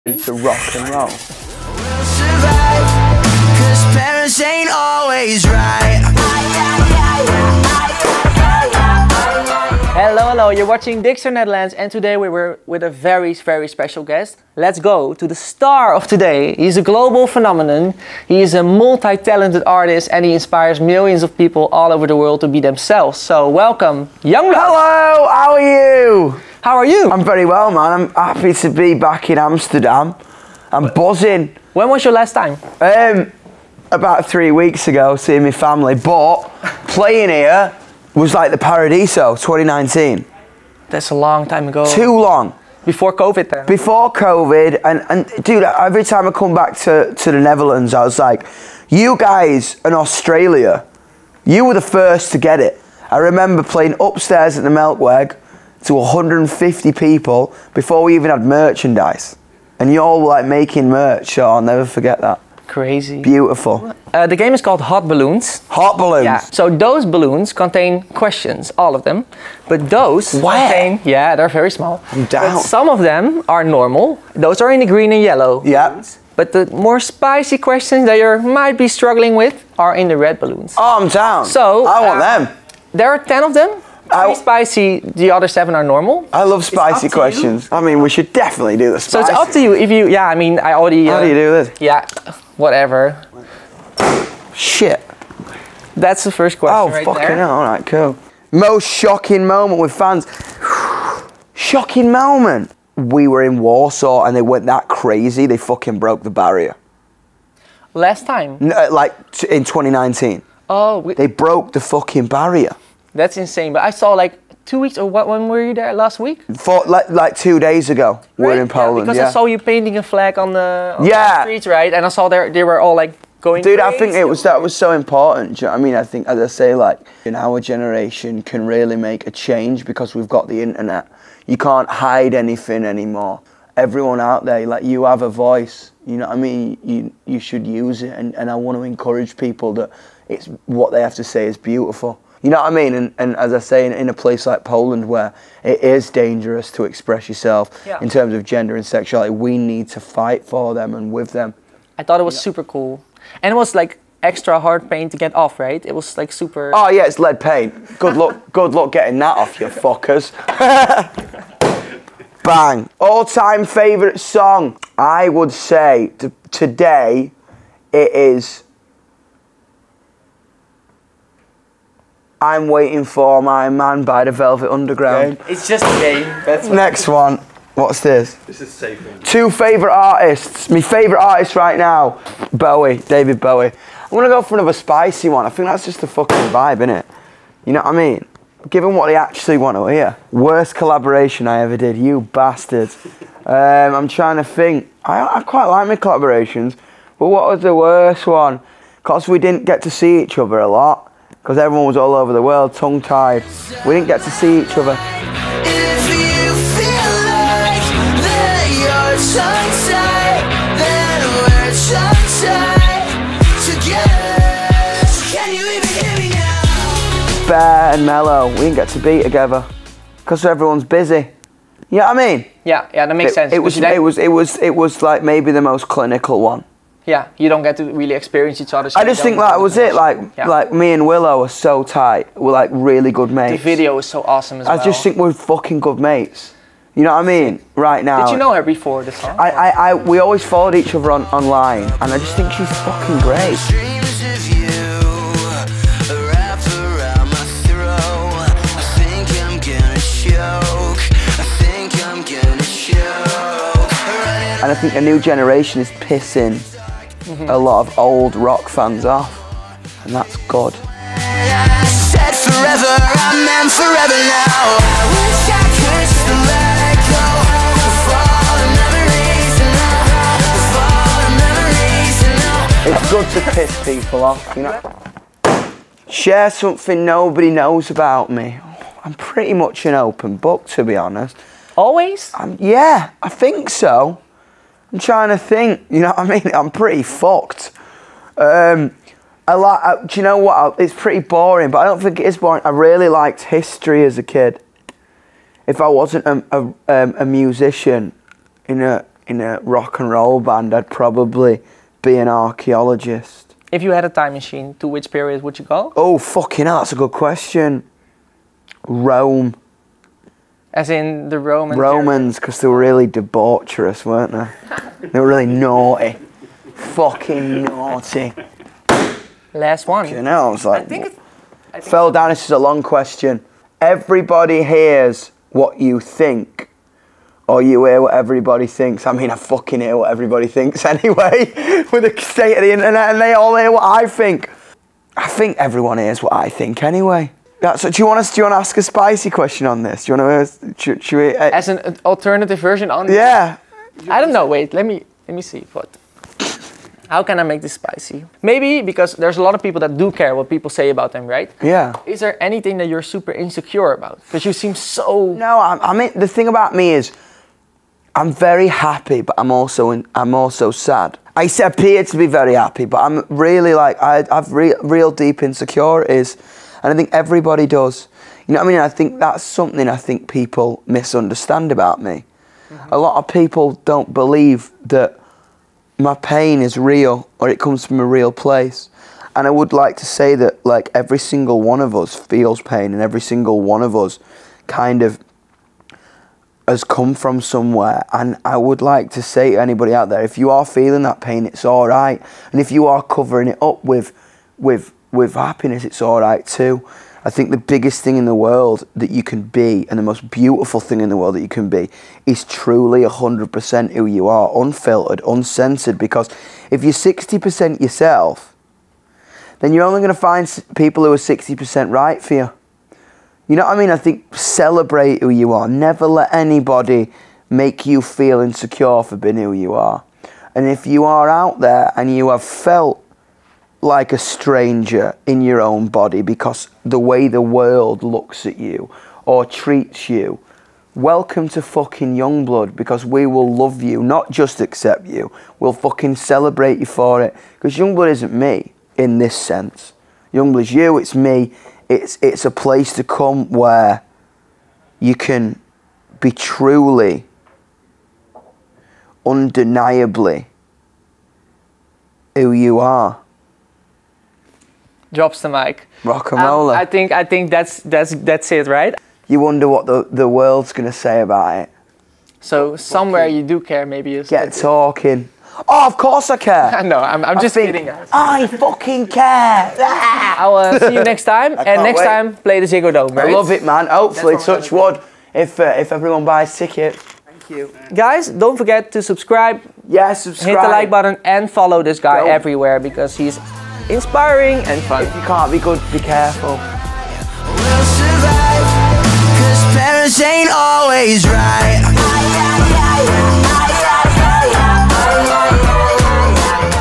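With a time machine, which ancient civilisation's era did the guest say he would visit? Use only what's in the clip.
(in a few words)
Rome.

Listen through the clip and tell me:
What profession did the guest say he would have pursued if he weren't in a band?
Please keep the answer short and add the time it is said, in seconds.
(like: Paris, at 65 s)
archaeologist, at 302 s.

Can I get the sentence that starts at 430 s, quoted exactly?
Welcome to fucking Yungblud because we will love you, not just accept you.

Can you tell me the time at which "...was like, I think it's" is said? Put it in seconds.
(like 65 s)
320 s.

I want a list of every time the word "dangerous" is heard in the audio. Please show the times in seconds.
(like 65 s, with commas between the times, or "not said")
146 s.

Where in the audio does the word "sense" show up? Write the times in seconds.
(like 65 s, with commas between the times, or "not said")
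223 s, 439 s.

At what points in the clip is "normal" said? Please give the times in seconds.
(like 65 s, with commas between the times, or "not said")
73 s, 85 s.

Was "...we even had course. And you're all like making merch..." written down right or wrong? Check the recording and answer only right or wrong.
wrong.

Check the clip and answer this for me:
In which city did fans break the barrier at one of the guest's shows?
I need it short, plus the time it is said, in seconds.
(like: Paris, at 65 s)
Warsaw, at 103 s.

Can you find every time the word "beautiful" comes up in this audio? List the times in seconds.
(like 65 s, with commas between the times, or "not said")
63 s, 141 s, 400 s.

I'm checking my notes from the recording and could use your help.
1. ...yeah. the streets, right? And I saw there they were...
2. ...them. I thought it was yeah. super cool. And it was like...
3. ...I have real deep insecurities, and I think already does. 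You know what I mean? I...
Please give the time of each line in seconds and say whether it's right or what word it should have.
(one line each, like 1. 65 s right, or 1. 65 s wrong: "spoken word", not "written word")
1. 121 s right
2. 151 s right
3. 364 s wrong: "everybody", not "already".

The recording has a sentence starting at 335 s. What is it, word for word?
I think everyone hears what I think anyway.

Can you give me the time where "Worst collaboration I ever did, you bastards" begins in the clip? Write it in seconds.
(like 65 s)
190 s.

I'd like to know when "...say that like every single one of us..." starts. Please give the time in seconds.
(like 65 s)
380 s.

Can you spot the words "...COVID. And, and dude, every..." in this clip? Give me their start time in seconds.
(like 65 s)
44 s.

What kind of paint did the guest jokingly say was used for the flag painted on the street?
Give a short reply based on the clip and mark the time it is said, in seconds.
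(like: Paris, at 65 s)
lead paint, at 157 s.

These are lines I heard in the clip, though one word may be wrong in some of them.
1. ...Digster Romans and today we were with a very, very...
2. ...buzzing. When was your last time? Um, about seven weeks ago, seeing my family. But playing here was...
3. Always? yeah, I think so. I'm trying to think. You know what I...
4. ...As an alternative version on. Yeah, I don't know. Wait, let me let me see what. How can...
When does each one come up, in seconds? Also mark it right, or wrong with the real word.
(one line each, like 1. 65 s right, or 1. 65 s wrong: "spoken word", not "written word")
1. 11 s wrong: "Netherlands", not "Romans"
2. 30 s wrong: "three", not "seven"
3. 281 s right
4. 341 s right.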